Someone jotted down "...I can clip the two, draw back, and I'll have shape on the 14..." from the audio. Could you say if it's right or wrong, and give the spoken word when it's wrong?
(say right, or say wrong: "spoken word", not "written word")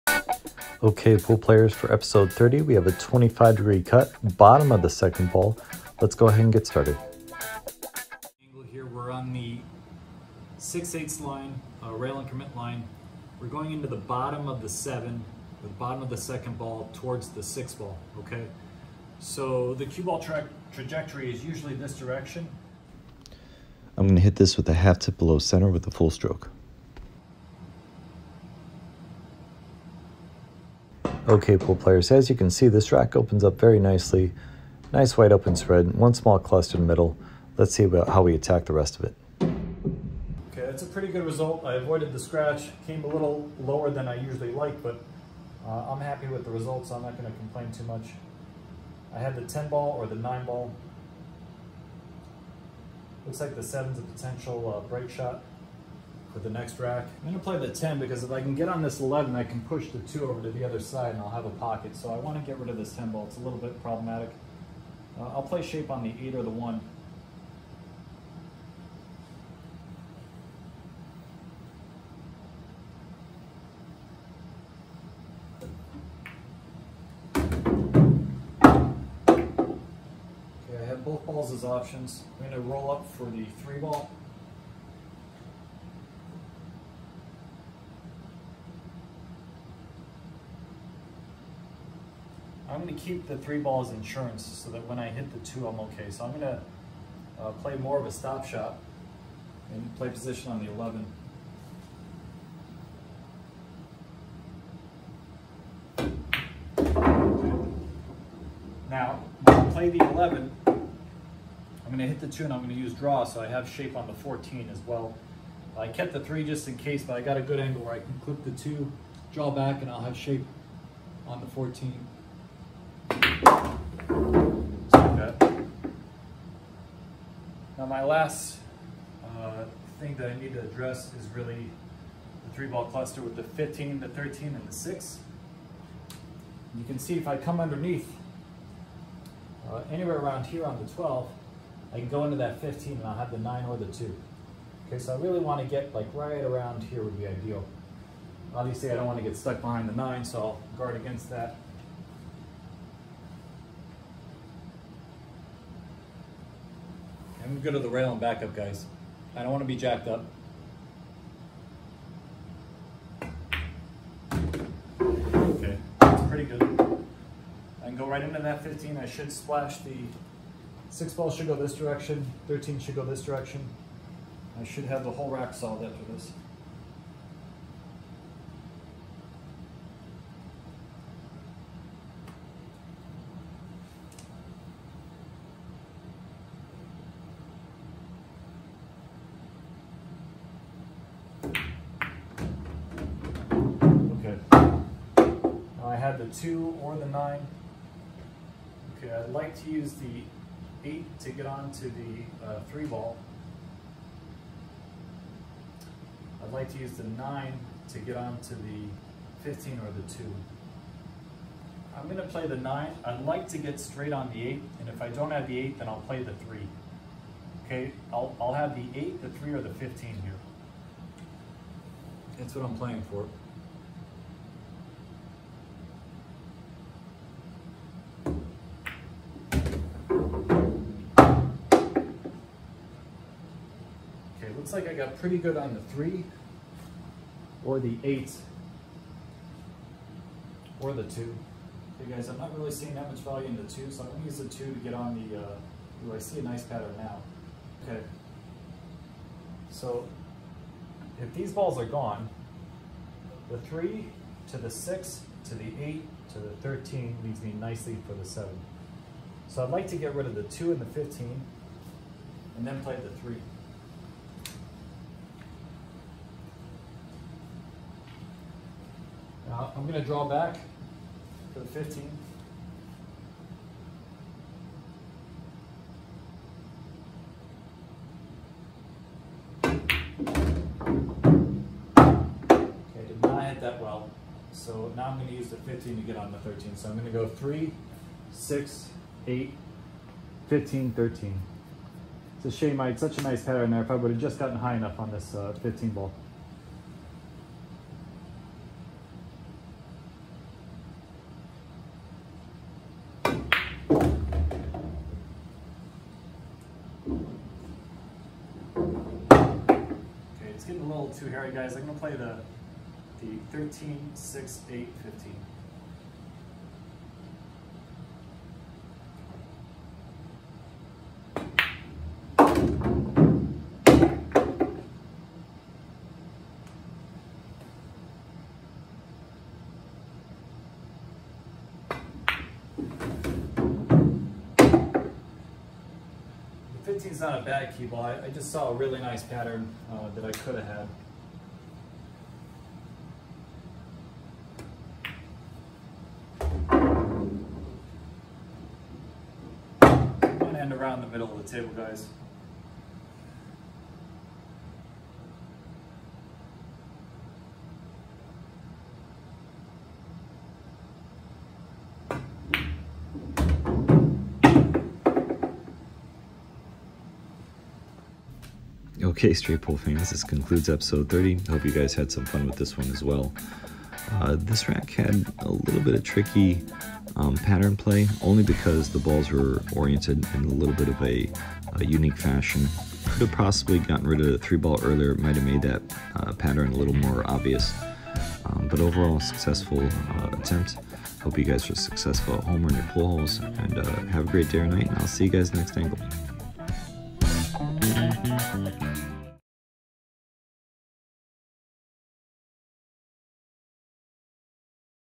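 right.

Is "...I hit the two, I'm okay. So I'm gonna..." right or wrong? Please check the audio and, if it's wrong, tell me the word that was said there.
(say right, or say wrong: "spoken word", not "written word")
right.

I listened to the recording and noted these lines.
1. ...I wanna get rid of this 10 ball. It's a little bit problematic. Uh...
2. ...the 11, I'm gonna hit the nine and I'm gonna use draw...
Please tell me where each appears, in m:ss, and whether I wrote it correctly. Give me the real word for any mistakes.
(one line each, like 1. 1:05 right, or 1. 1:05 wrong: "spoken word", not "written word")
1. 1:02 right
2. 1:49 wrong: "two", not "nine".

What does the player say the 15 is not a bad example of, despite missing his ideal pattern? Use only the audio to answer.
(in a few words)
key ball.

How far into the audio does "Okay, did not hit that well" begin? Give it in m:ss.
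4:39.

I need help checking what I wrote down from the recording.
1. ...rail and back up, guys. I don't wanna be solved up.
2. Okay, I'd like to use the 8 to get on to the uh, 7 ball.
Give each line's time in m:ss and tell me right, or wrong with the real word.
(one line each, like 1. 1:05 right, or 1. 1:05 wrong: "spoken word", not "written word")
1. 2:37 wrong: "jacked", not "solved"
2. 3:18 wrong: "3", not "7".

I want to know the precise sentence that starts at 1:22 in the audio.
I'm gonna roll up for the three ball.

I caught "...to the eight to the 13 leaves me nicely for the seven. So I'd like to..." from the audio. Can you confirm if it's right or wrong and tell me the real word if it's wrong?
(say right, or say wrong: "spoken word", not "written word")
right.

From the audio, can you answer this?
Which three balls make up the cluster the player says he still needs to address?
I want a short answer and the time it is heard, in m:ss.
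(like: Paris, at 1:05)
15, 13 and 6, at 2:13.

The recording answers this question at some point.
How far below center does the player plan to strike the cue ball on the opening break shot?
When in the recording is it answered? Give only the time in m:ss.
0:24.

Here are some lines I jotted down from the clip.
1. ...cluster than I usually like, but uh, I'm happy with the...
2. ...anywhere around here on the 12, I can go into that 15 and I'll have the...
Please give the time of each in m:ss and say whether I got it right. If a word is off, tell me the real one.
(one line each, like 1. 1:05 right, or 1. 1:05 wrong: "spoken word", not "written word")
1. 0:43 wrong: "lower", not "cluster"
2. 2:19 right.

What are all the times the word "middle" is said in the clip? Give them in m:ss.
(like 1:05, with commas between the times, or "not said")
0:36, 5:51.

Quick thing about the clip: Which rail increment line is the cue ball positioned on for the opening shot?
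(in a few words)
6 eighths line.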